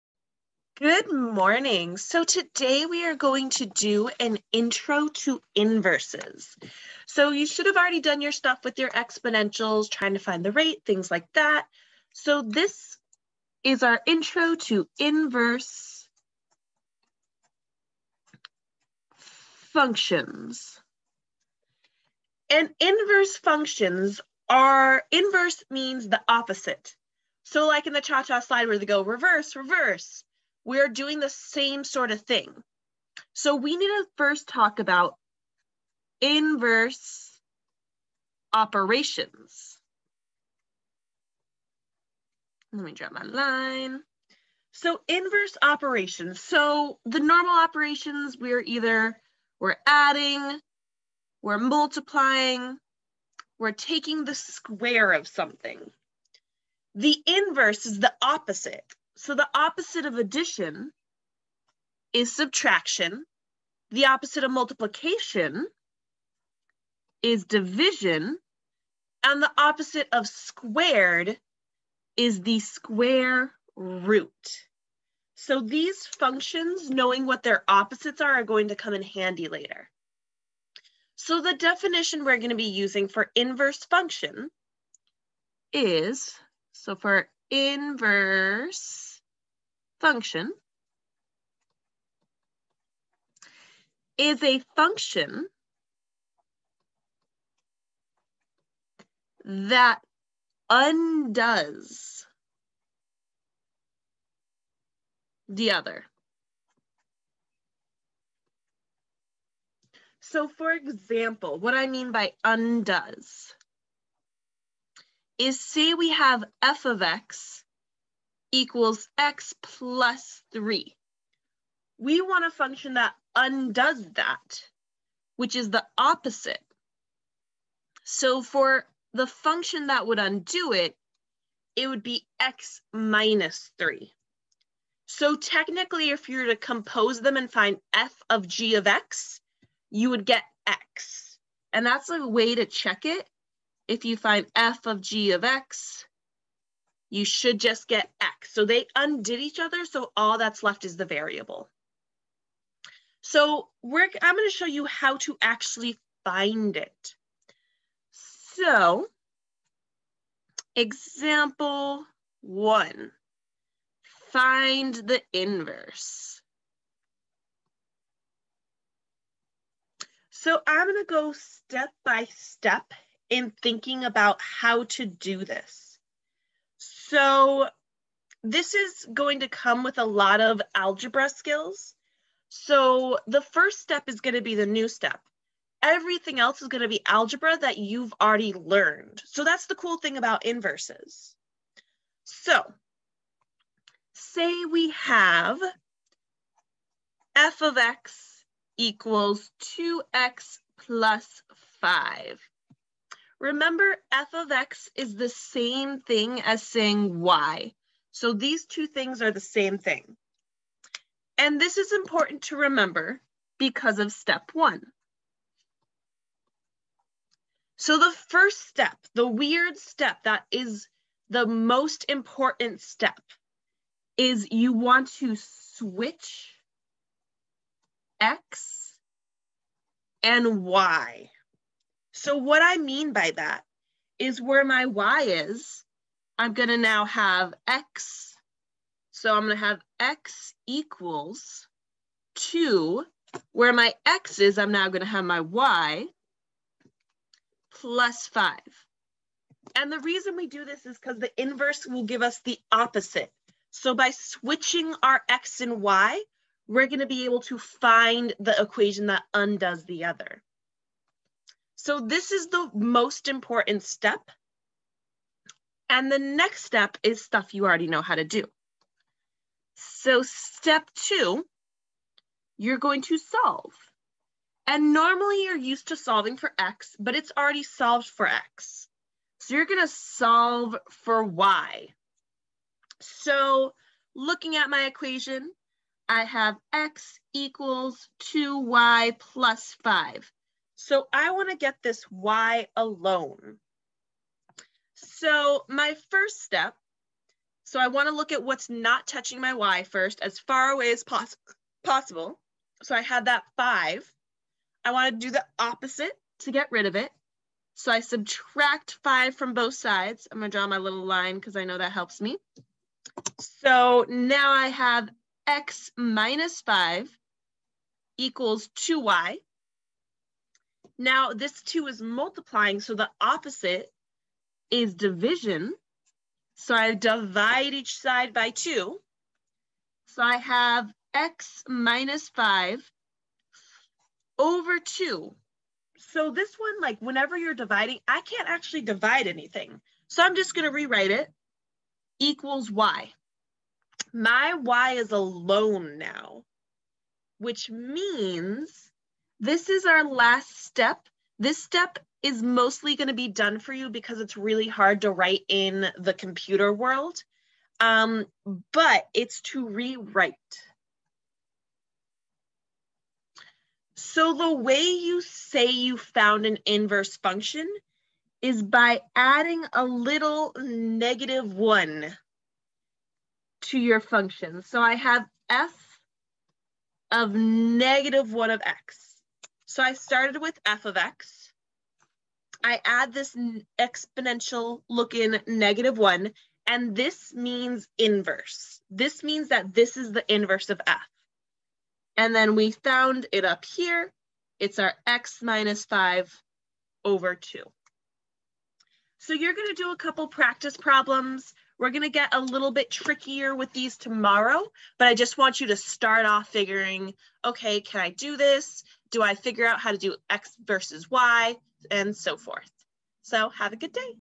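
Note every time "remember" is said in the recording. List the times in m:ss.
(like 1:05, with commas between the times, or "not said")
3:23, 3:32.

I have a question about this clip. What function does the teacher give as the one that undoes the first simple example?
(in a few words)
x minus 3.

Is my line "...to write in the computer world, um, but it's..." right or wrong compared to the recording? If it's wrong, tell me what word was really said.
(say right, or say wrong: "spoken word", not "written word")
right.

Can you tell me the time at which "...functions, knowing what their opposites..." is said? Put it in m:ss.
1:16.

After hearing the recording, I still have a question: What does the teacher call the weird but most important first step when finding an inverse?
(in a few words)
switch X and Y.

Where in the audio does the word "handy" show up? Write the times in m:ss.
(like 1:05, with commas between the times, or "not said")
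1:19.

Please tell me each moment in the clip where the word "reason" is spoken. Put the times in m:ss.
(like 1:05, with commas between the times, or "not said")
4:10.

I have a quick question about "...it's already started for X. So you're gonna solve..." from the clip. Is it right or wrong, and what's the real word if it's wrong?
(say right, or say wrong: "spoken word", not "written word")
wrong: "solved", not "started".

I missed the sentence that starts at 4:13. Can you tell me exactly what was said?
So by switching our x and y, we're going to be able to find the equation that undoes the other.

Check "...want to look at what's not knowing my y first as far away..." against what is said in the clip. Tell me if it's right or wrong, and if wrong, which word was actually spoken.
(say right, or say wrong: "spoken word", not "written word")
wrong: "touching", not "knowing".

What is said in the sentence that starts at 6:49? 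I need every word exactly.
Do I figure out how to do X versus Y and so forth?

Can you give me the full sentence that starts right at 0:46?
So the normal operations, we're either, we're adding, we're multiplying, we're taking the square of something.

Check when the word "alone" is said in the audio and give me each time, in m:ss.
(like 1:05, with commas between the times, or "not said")
4:52, 5:45.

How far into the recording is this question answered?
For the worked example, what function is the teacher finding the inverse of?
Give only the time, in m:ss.
3:19.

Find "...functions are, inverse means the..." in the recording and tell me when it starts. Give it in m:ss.
0:23.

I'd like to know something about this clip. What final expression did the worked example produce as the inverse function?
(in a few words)
x minus 5 over 2.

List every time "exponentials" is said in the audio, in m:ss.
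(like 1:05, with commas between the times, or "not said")
0:08, 6:23.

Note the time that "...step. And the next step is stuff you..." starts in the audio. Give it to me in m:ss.
4:23.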